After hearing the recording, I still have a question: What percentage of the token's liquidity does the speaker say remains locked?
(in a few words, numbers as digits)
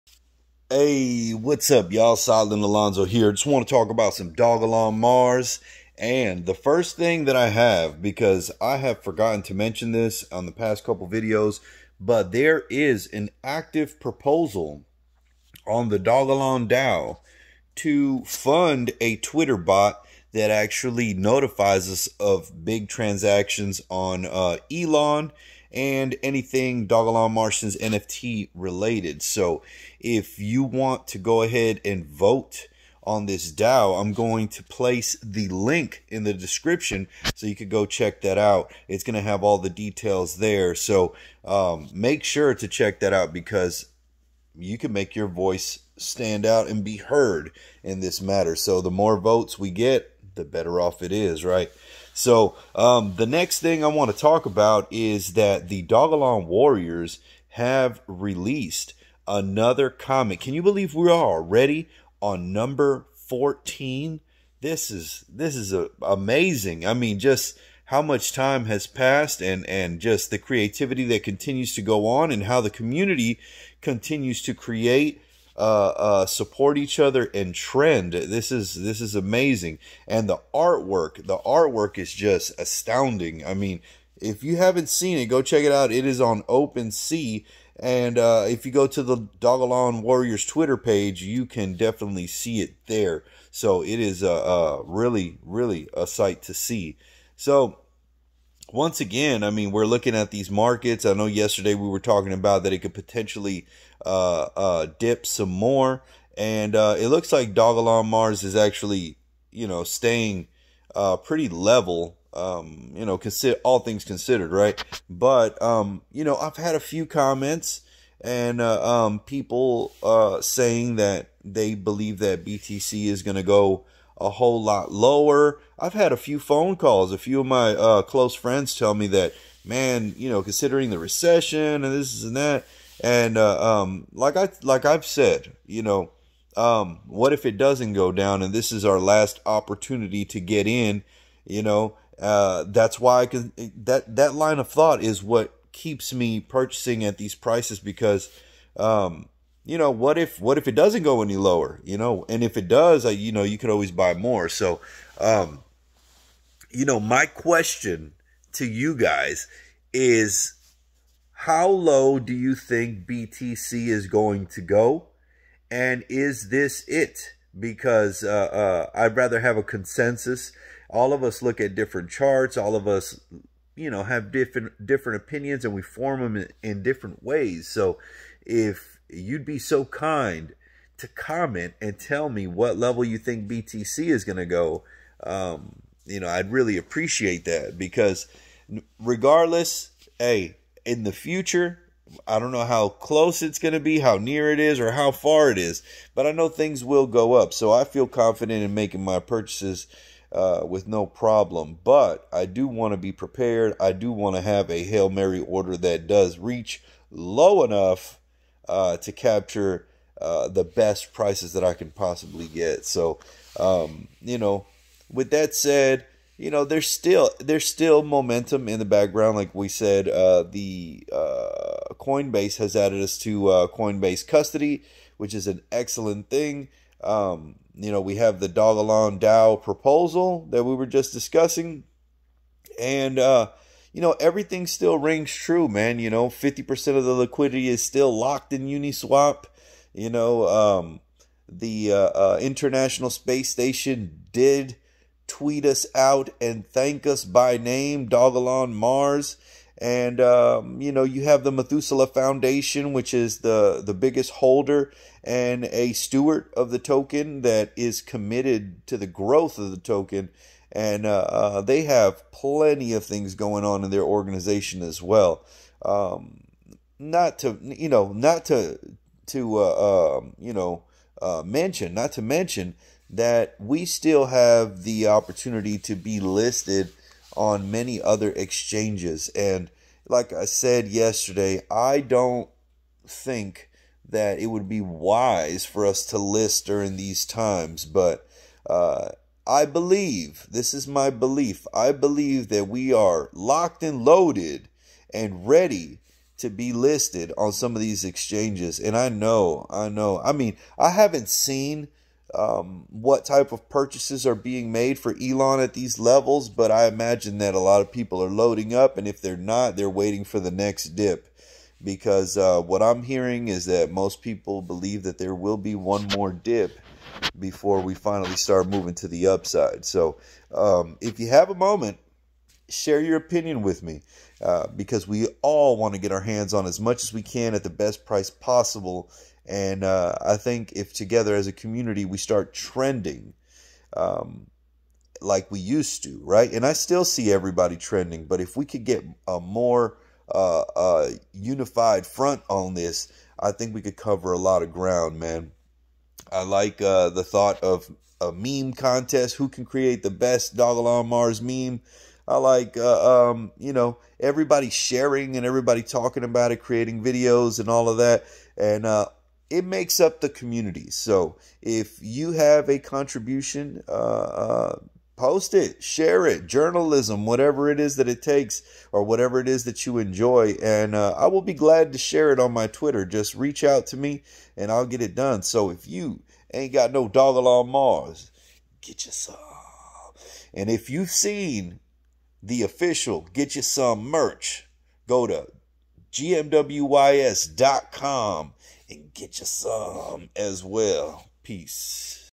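50%.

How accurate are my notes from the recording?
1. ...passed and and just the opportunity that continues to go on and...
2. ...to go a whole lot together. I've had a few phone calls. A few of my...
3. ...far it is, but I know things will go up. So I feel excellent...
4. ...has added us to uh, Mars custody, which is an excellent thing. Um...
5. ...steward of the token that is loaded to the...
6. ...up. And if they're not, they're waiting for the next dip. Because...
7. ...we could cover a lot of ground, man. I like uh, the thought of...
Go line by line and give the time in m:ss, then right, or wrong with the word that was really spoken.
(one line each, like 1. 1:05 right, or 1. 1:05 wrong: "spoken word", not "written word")
1. 1:08 wrong: "creativity", not "opportunity"
2. 2:03 wrong: "lower", not "together"
3. 3:15 wrong: "confident", not "excellent"
4. 3:42 wrong: "Coinbase", not "Mars"
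5. 4:15 wrong: "committed", not "loaded"
6. 5:08 right
7. 5:43 right.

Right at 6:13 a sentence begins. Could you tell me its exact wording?
Just reach out to me and I'll get it done.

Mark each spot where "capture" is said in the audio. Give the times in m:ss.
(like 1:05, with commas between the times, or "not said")
3:29.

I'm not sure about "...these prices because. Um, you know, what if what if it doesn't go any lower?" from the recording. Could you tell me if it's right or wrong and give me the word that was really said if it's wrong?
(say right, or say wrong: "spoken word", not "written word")
right.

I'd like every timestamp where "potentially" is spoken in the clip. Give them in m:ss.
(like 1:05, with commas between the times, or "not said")
1:42.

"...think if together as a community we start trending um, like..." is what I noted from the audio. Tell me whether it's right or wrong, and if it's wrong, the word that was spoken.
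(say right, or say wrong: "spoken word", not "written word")
right.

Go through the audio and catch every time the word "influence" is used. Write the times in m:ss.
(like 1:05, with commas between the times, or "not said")
not said.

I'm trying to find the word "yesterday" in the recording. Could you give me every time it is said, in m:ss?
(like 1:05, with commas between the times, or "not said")
1:41, 4:40.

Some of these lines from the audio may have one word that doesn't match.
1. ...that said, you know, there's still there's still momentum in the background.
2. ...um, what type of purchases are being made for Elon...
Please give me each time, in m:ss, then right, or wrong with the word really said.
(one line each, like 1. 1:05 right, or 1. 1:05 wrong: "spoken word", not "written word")
1. 3:35 right
2. 5:02 right.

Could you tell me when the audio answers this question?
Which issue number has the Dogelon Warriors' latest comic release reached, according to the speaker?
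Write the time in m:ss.
1:02.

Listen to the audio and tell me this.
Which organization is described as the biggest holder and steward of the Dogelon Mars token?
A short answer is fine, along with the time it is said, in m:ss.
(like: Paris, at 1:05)
Methuselah Foundation, at 4:11.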